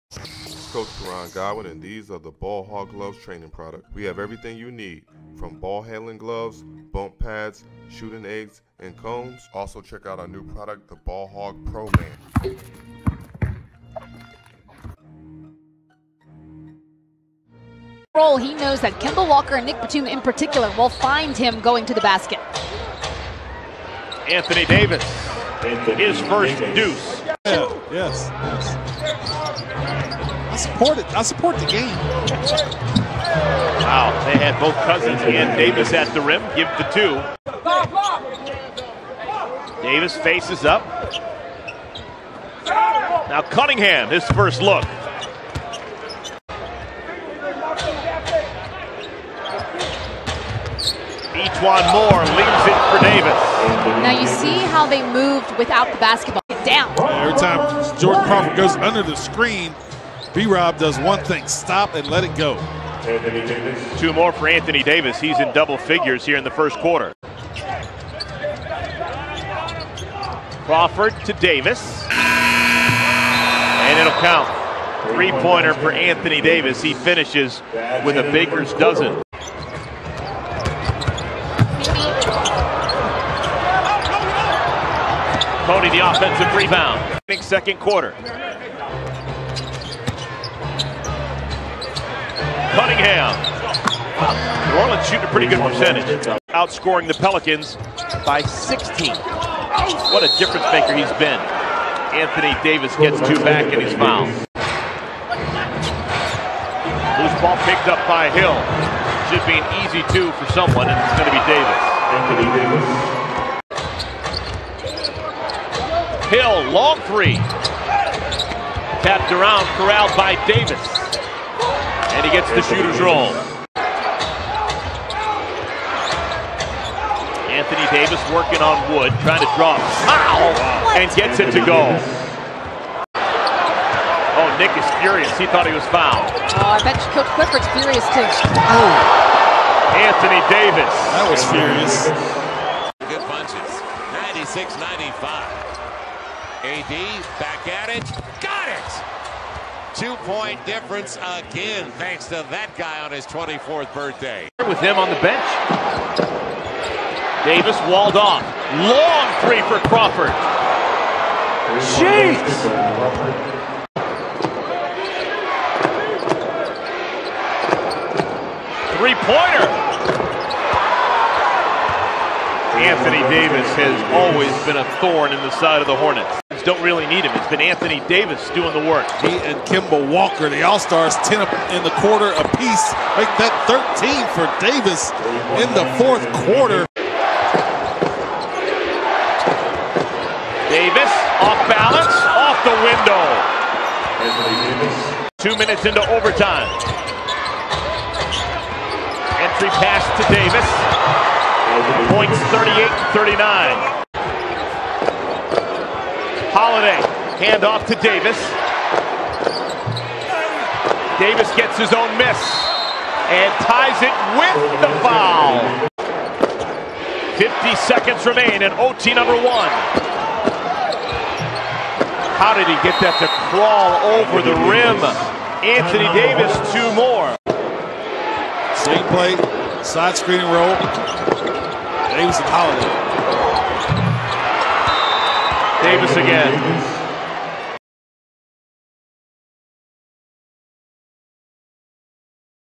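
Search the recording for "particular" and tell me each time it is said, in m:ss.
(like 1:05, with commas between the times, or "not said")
0:20.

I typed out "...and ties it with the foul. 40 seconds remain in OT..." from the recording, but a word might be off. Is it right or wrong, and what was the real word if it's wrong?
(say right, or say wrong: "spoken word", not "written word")
wrong: "50", not "40".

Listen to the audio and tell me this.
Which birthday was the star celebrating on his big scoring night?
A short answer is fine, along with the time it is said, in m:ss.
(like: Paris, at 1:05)
24th, at 2:33.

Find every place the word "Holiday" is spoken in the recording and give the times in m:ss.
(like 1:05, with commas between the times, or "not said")
3:26, 3:52.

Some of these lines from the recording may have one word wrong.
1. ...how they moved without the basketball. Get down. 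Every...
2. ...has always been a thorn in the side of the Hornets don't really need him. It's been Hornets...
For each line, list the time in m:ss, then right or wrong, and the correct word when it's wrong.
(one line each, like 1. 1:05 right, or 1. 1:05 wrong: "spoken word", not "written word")
1. 0:54 right
2. 2:53 wrong: "Anthony", not "Hornets".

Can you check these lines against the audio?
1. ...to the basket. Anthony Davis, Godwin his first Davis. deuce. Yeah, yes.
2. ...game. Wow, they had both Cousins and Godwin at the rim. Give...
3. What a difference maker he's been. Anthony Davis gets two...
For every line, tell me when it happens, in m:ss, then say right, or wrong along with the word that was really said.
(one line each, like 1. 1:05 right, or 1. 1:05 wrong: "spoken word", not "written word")
1. 0:21 wrong: "Anthony", not "Godwin"
2. 0:31 wrong: "Davis", not "Godwin"
3. 1:40 right.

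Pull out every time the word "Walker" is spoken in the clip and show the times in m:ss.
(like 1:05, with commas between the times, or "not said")
0:19, 3:00.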